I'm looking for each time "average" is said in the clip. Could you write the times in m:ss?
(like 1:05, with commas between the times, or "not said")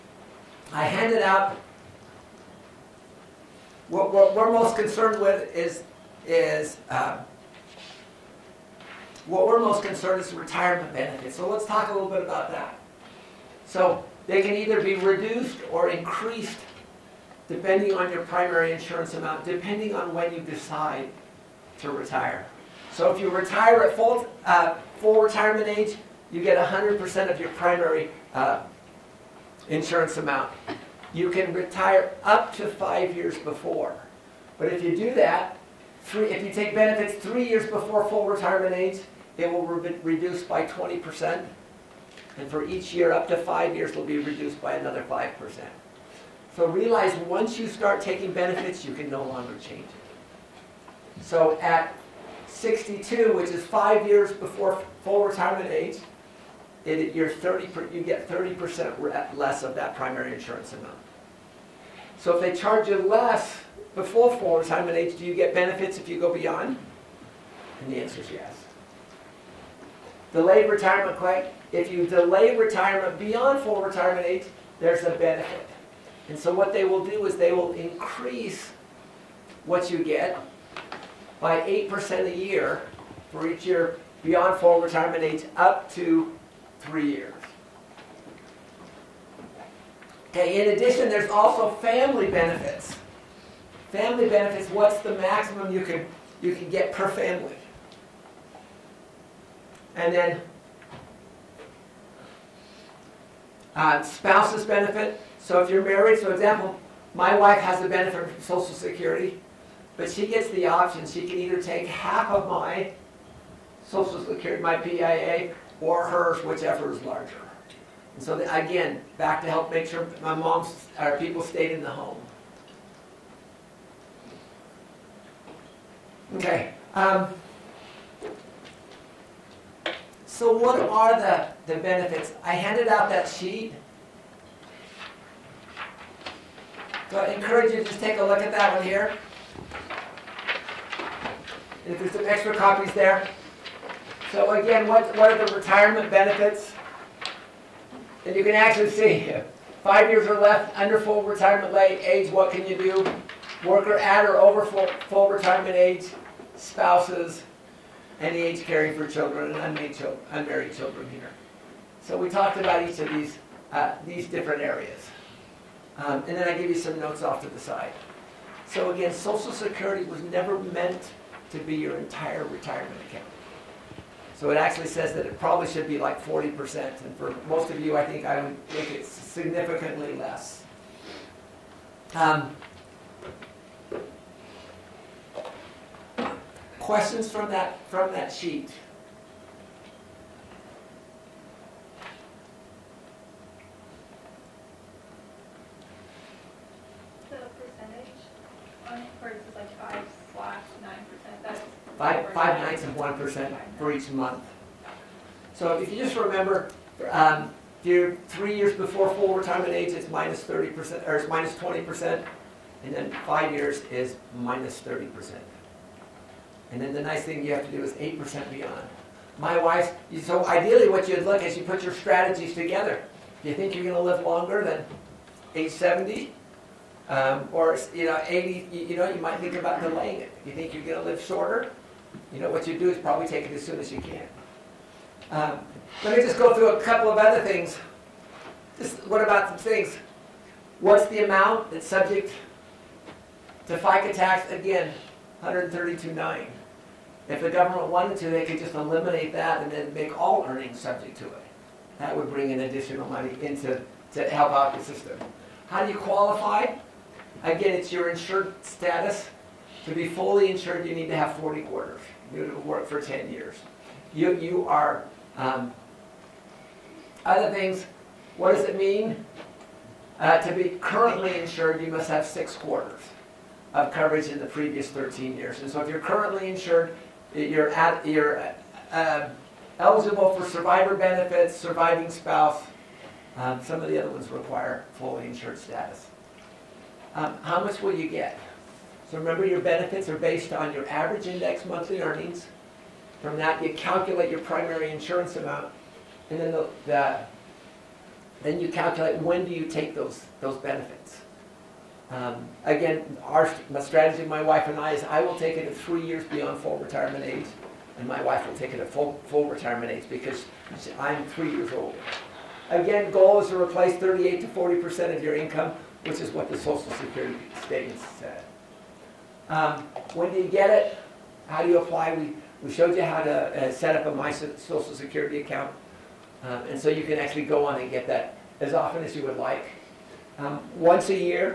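4:50.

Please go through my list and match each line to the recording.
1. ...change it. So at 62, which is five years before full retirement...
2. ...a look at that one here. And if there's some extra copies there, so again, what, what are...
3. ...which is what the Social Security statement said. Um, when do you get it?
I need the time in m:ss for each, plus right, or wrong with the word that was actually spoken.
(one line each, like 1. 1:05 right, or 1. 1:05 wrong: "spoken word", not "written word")
1. 0:49 right
2. 2:18 right
3. 5:16 right.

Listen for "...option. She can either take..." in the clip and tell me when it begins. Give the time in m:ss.
1:50.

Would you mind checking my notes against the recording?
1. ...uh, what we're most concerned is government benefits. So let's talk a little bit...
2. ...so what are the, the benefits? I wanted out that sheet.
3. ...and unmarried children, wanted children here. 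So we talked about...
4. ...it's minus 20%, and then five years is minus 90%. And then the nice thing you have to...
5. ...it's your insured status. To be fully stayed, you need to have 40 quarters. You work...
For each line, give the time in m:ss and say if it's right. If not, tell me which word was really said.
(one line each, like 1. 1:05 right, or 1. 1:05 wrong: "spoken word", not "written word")
1. 0:06 wrong: "retirement", not "government"
2. 2:10 wrong: "handed", not "wanted"
3. 2:39 wrong: "unmarried", not "wanted"
4. 3:31 wrong: "30", not "90"
5. 4:17 wrong: "insured", not "stayed".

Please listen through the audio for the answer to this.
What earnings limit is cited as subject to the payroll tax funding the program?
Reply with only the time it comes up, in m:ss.
4:05.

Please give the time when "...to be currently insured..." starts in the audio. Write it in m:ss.
4:30.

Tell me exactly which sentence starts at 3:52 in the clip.
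You know, what you do is probably take it as soon as you can.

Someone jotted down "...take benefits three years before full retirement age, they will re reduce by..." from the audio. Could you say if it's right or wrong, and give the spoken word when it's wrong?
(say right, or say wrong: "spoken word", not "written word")
right.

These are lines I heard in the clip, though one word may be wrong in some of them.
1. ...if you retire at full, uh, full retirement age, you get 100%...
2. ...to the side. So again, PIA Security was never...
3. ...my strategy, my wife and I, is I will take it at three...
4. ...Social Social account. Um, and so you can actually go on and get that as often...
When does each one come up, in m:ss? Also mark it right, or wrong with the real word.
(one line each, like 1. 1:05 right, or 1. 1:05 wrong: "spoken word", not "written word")
1. 0:23 right
2. 2:47 wrong: "Social", not "PIA"
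3. 5:03 right
4. 5:24 wrong: "Security", not "Social".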